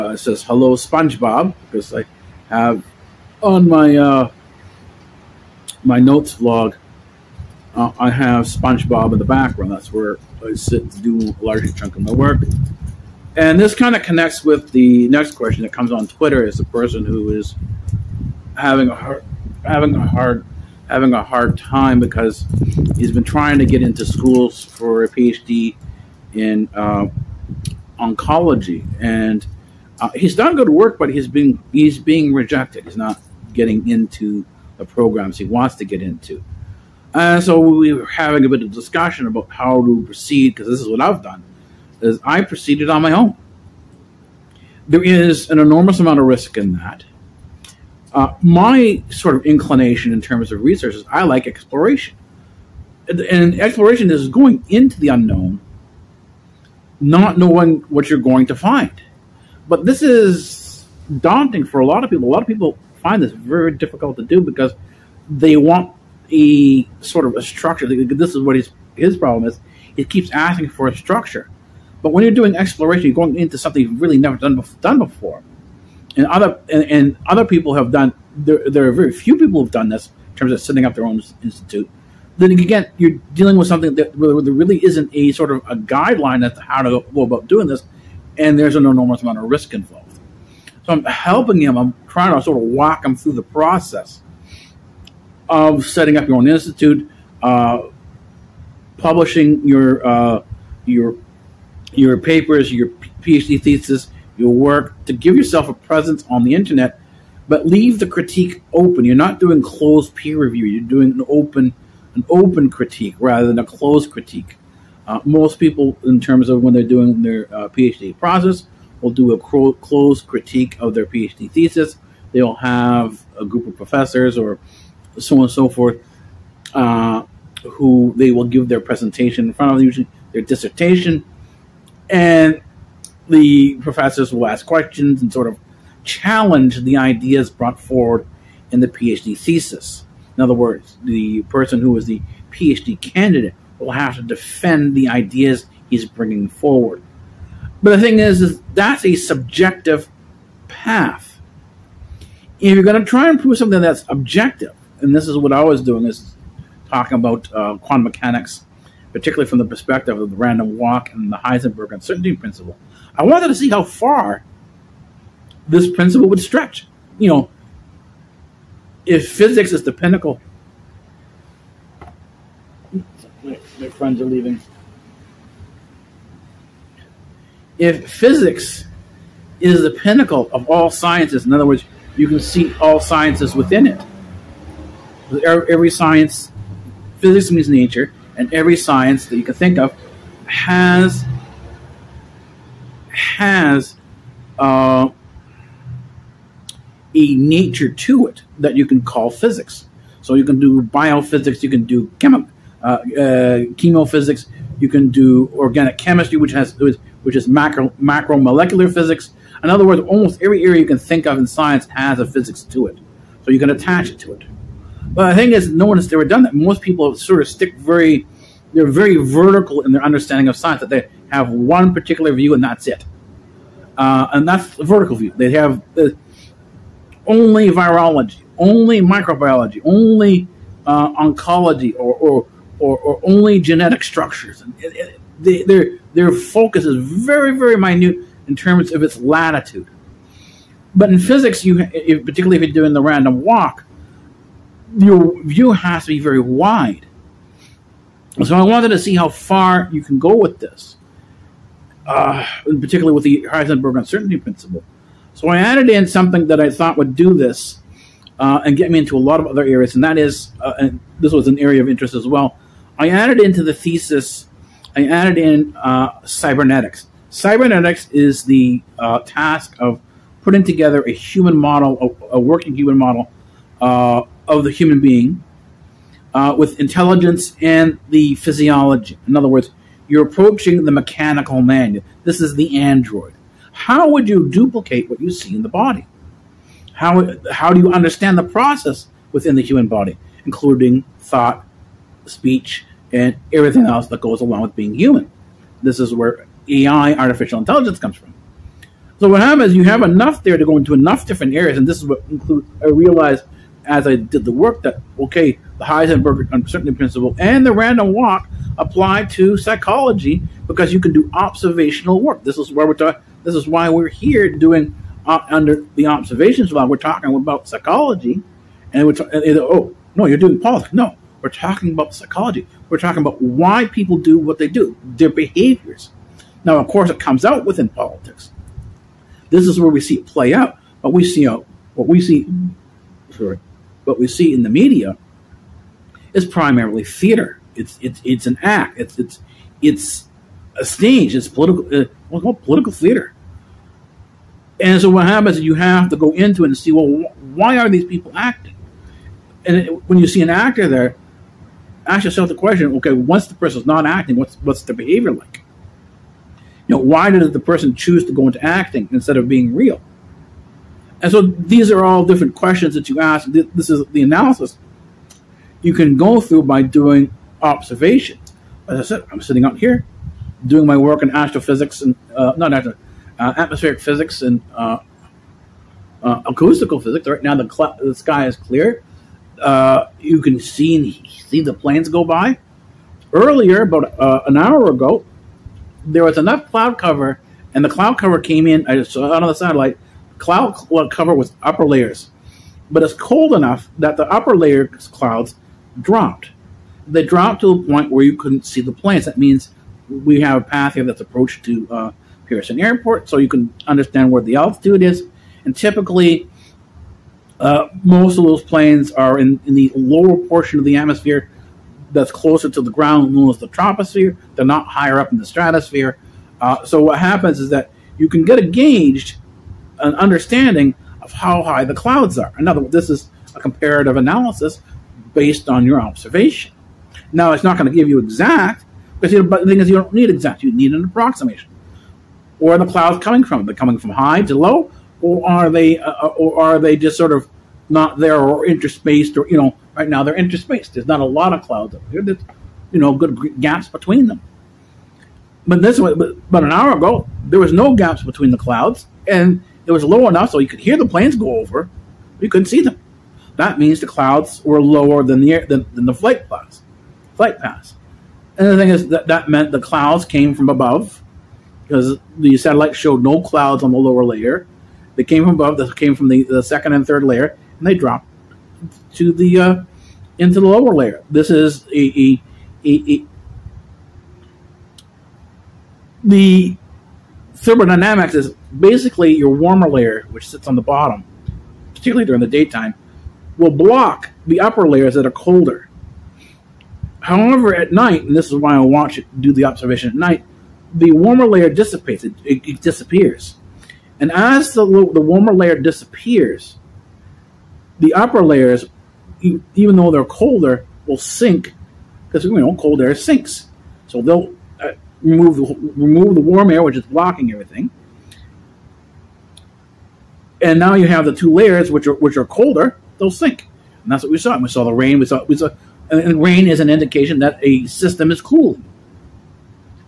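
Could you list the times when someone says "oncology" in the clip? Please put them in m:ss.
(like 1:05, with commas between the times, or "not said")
0:27, 3:51.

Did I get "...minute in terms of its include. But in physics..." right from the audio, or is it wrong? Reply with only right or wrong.
wrong.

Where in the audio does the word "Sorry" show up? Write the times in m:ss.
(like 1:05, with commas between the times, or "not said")
5:33.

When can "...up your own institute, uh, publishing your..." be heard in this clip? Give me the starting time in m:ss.
1:36.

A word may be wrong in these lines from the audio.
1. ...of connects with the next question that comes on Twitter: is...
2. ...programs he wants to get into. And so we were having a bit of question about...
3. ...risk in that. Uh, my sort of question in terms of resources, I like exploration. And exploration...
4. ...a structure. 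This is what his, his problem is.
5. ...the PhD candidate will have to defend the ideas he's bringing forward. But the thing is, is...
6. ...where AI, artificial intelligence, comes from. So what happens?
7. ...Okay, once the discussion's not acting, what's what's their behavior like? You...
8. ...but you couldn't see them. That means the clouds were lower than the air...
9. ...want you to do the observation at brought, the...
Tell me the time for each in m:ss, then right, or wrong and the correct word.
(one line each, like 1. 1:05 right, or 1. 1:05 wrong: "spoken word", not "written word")
1. 0:13 right
2. 0:34 wrong: "discussion", not "question"
3. 0:46 wrong: "inclination", not "question"
4. 1:07 right
5. 2:22 right
6. 4:56 right
7. 5:52 wrong: "person", not "discussion"
8. 7:32 right
9. 8:08 wrong: "night", not "brought".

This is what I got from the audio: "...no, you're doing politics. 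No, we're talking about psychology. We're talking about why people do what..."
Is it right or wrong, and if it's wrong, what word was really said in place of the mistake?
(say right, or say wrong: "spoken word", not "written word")
right.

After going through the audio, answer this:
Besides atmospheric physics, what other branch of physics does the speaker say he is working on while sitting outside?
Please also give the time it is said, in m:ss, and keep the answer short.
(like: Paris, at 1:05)
Acoustical physics, at 6:16.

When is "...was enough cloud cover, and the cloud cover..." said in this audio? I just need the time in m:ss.
6:26.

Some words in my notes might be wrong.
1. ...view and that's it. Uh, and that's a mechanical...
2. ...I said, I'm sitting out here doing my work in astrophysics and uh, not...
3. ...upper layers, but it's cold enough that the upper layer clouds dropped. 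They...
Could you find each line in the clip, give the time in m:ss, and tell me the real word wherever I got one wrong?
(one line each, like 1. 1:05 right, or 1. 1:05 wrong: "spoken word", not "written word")
1. 3:42 wrong: "vertical", not "mechanical"
2. 6:08 right
3. 6:31 right.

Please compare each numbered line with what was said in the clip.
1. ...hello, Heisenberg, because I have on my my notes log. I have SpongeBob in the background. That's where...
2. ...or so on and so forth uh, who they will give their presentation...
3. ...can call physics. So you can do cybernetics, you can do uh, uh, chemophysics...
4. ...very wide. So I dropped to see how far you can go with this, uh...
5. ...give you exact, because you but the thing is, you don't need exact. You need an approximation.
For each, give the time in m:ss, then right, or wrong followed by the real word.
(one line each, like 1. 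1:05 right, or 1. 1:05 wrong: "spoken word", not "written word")
1. 0:00 wrong: "SpongeBob", not "Heisenberg"
2. 2:04 right
3. 3:18 wrong: "biophysics", not "cybernetics"
4. 4:06 wrong: "wanted", not "dropped"
5. 7:07 right.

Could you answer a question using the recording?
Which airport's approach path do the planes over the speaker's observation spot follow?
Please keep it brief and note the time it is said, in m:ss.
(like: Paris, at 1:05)
Pearson Airport, at 6:42.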